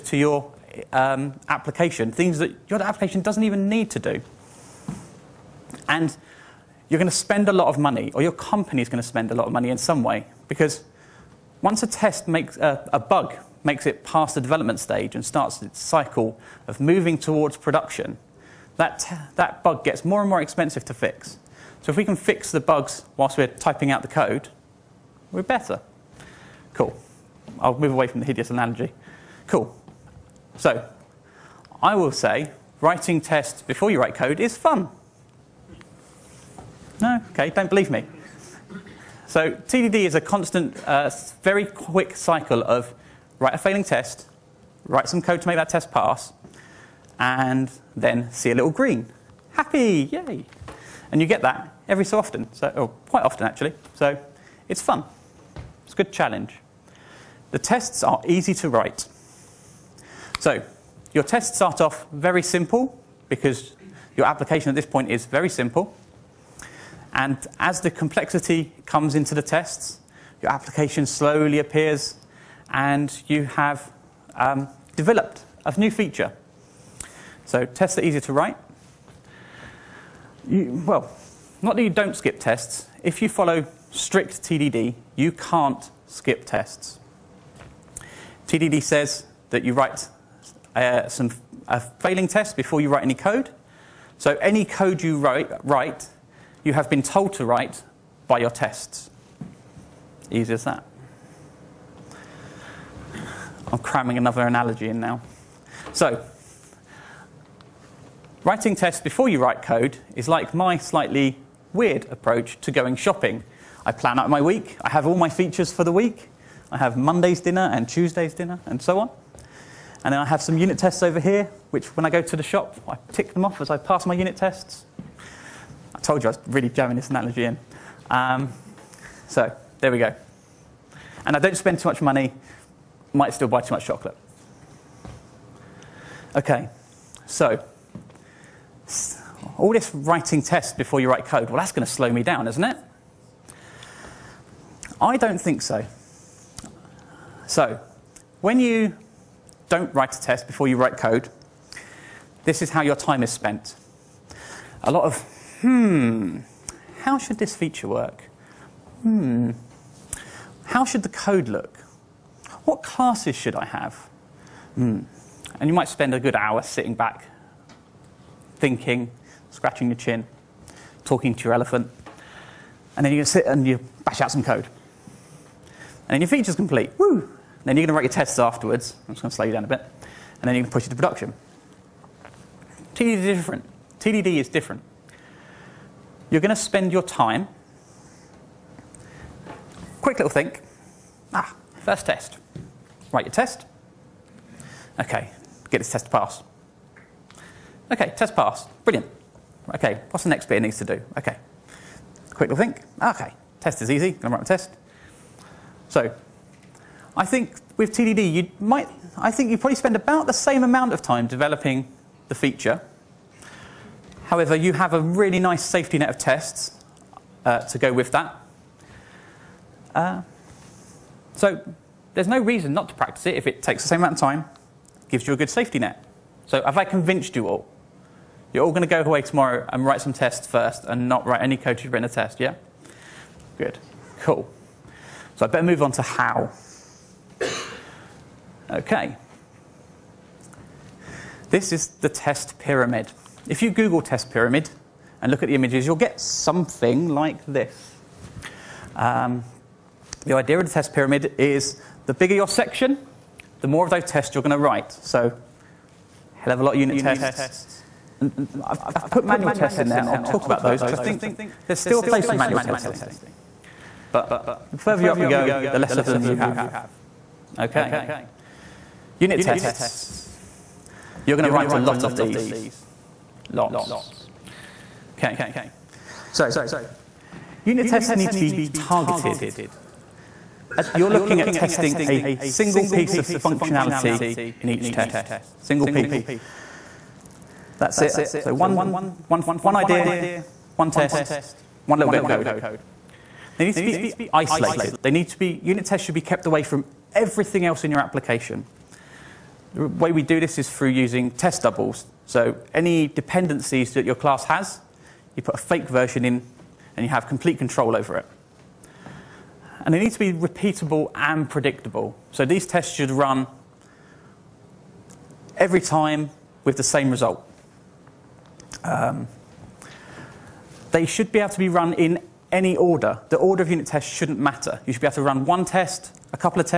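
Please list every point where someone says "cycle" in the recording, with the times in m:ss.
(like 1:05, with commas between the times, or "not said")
0:15, 0:42.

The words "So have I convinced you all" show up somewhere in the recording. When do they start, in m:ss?
3:46.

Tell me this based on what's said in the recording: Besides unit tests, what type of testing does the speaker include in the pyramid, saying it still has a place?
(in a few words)
manual tests.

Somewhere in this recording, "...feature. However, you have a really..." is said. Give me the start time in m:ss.
3:32.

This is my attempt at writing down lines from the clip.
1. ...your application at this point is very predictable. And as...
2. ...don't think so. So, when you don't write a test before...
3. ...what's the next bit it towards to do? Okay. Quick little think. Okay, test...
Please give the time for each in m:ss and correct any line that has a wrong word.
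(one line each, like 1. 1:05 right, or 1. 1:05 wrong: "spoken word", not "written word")
1. 1:04 wrong: "simple", not "predictable"
2. 2:25 right
3. 3:20 wrong: "needs", not "towards".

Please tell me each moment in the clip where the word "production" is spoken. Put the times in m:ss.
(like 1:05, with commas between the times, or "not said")
0:17, 3:00.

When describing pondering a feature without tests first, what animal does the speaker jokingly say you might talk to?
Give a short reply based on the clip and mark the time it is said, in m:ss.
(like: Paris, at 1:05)
elephant, at 2:51.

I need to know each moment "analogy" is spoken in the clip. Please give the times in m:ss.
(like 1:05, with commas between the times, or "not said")
0:28, 1:44, 2:07.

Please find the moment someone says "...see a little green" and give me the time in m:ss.
0:48.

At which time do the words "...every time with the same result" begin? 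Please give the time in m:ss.
5:15.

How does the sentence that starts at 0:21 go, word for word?
So if we can fix the bugs whilst we're typing out the code, we're better.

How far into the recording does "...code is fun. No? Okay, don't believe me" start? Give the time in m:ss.
0:34.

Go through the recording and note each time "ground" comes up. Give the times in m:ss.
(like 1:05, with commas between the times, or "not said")
not said.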